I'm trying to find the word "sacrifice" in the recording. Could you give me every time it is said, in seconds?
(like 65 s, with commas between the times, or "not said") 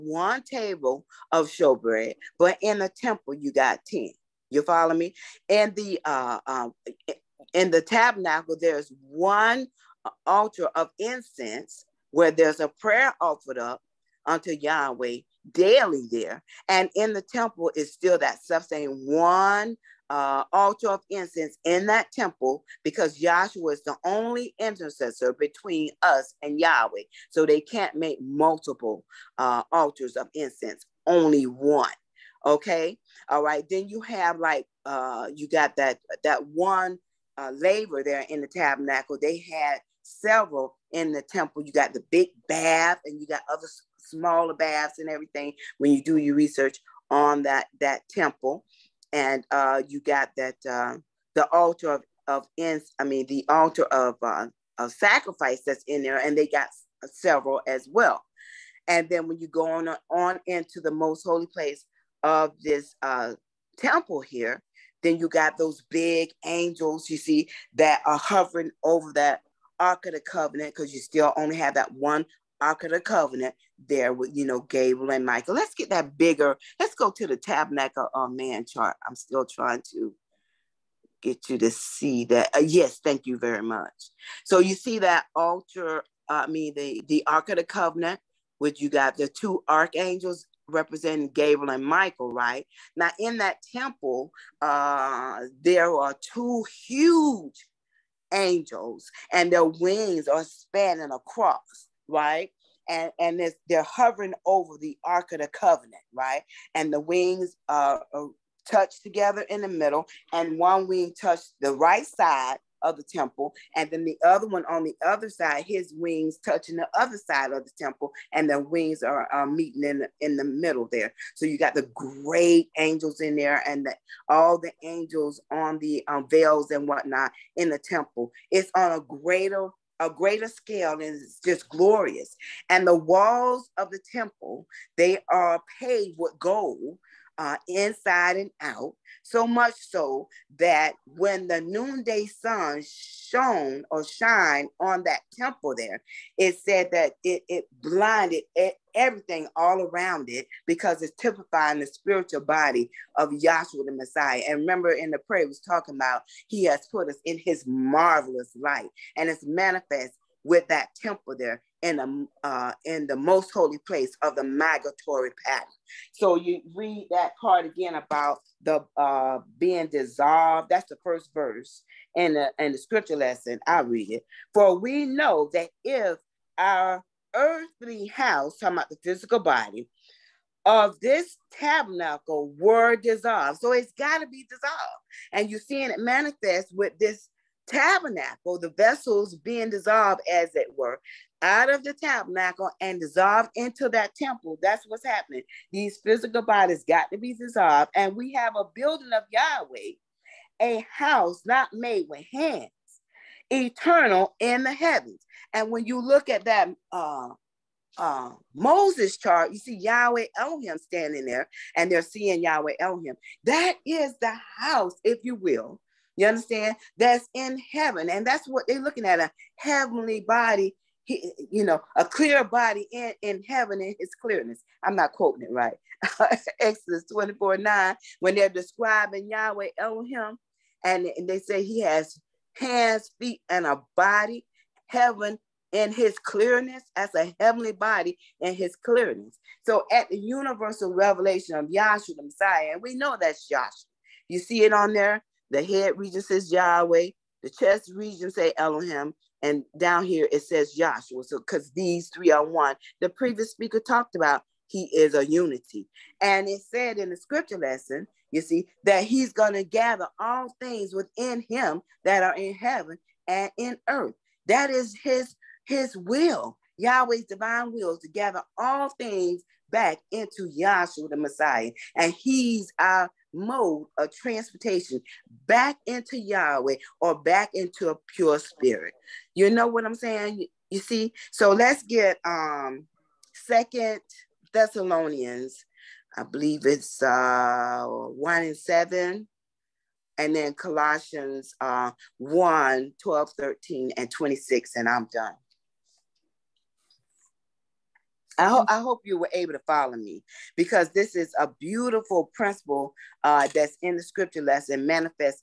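54 s.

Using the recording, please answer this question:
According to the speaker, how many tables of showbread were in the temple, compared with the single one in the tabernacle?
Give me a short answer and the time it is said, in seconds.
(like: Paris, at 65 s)
10, at 3 s.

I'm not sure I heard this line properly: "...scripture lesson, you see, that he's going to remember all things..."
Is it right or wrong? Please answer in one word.
wrong.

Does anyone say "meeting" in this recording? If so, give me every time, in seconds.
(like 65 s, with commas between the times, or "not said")
119 s.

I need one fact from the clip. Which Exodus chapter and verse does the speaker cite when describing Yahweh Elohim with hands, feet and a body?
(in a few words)
Exodus 24:9.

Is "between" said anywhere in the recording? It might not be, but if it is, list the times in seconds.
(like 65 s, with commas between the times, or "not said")
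25 s.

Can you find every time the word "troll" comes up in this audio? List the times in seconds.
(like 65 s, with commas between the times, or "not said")
not said.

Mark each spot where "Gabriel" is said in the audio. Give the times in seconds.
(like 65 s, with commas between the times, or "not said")
74 s, 91 s.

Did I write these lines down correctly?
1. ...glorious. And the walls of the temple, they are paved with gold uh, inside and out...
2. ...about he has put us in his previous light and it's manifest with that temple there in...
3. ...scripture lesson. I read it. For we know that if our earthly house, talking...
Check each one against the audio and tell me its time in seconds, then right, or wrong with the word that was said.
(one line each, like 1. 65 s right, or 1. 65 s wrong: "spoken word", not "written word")
1. 131 s right
2. 155 s wrong: "marvelous", not "previous"
3. 172 s right.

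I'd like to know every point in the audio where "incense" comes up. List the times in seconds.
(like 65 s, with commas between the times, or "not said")
10 s, 21 s, 30 s.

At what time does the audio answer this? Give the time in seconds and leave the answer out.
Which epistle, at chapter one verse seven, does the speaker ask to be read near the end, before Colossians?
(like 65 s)
283 s.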